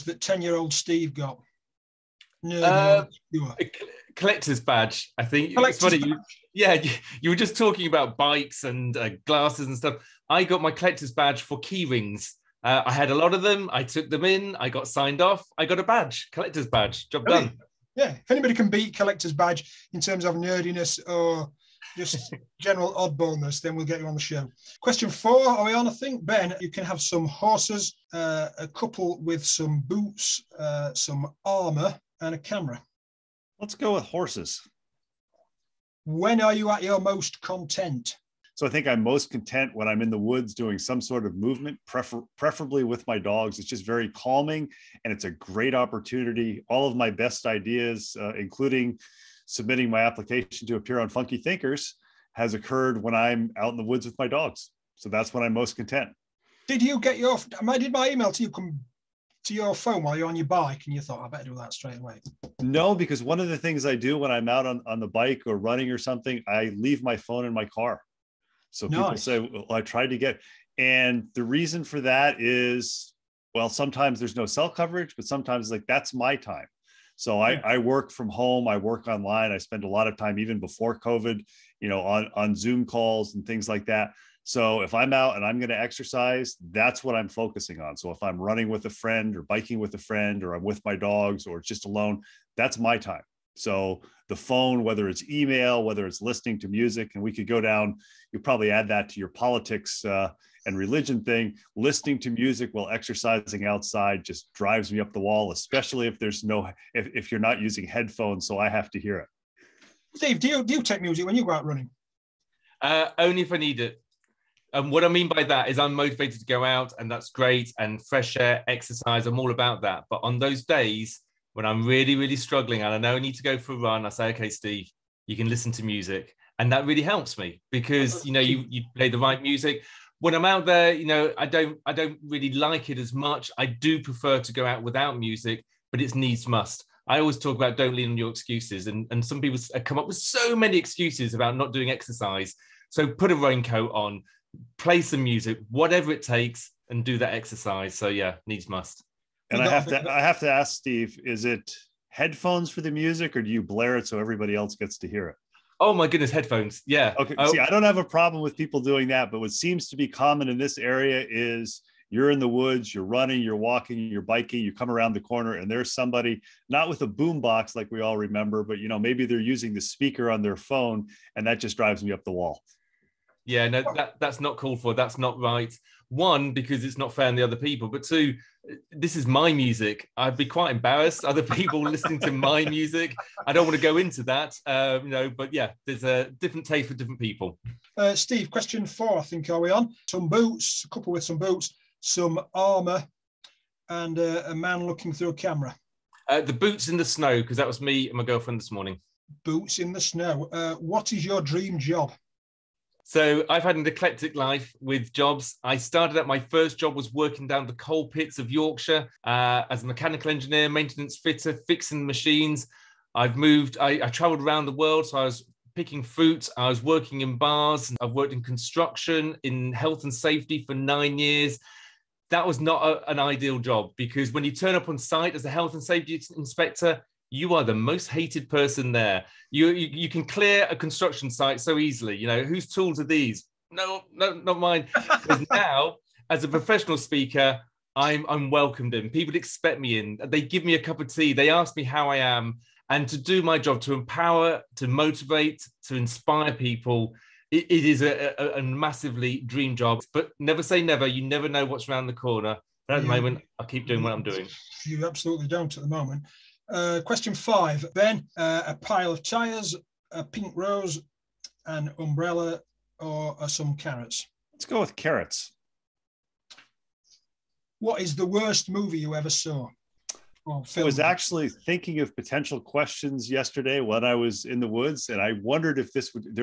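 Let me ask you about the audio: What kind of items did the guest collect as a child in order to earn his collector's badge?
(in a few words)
Key rings.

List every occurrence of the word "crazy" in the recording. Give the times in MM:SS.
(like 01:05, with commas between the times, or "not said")
not said.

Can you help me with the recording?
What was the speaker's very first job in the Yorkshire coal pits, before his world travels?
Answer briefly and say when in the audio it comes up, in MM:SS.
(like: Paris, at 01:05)
Mechanical engineer, at 03:29.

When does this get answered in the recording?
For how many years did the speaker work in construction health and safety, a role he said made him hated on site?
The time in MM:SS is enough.
03:40.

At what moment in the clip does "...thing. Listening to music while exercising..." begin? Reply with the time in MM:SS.
01:41.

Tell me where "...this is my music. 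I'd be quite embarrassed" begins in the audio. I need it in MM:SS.
02:58.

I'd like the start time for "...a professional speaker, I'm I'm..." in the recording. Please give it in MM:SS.
03:56.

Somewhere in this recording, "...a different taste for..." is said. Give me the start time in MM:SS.
03:06.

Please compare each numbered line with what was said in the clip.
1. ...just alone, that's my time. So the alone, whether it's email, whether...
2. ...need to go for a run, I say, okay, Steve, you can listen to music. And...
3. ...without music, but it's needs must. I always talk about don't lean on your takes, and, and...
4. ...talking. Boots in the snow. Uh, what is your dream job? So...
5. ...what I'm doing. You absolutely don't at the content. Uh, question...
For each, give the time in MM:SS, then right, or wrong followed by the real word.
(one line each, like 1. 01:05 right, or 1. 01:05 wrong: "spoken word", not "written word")
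1. 01:31 wrong: "phone", not "alone"
2. 02:03 right
3. 02:14 wrong: "excuses", not "takes"
4. 03:18 wrong: "morning", not "talking"
5. 04:14 wrong: "moment", not "content".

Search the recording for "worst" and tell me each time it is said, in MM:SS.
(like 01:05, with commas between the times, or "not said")
04:28.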